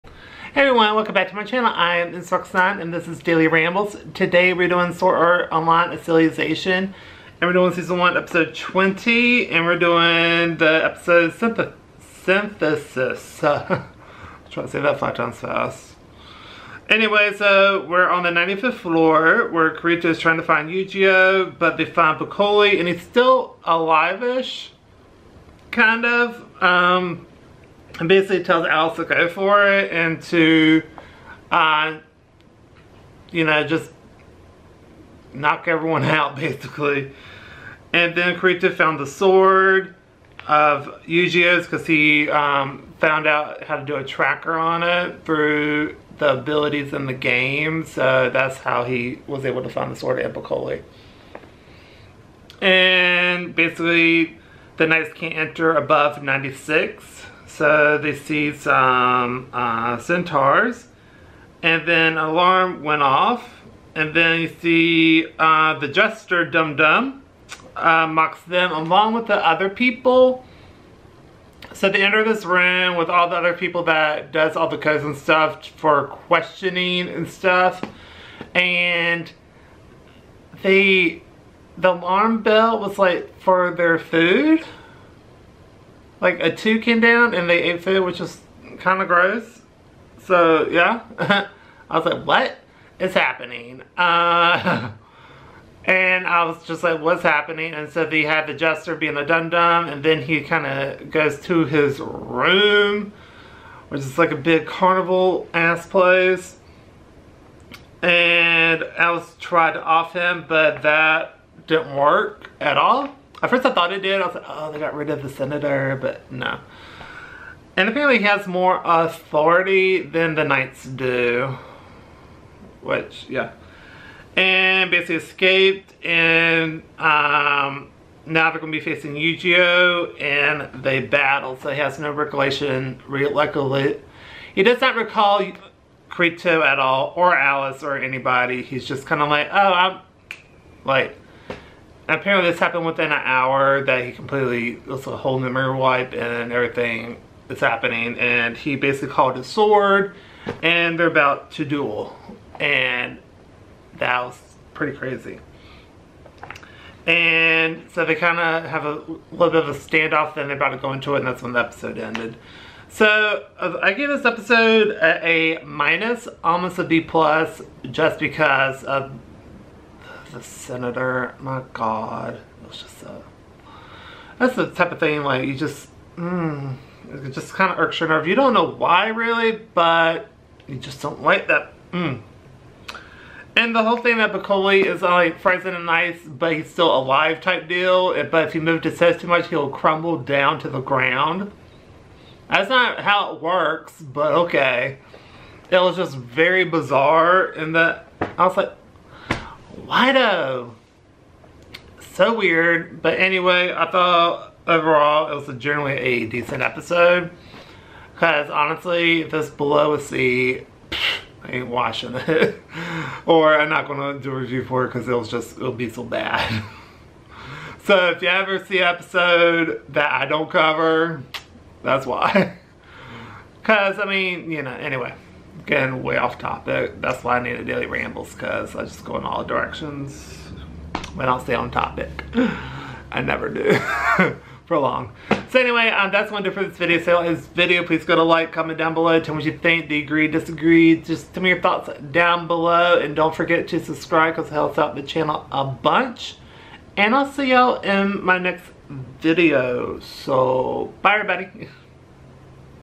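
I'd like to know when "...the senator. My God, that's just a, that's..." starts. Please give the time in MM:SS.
02:50.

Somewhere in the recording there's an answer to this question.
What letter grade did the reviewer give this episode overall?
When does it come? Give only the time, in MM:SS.
02:45.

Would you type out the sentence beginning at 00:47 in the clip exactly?
So that's how he was able to find the sword of Epicoli.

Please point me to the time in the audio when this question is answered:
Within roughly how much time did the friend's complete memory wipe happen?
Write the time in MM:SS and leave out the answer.
02:23.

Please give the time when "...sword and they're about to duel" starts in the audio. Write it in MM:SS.
02:29.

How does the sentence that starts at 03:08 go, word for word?
But if he moves his head too much, he'll crumble down to the ground.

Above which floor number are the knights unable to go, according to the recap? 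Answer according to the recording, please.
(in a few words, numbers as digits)
96.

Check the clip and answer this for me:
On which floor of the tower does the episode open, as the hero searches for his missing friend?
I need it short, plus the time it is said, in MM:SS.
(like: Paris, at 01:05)
95th floor, at 00:18.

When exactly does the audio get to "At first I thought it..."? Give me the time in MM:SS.
01:53.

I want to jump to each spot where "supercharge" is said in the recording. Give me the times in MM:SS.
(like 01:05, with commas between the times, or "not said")
not said.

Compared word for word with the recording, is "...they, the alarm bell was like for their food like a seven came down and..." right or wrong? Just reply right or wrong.
wrong.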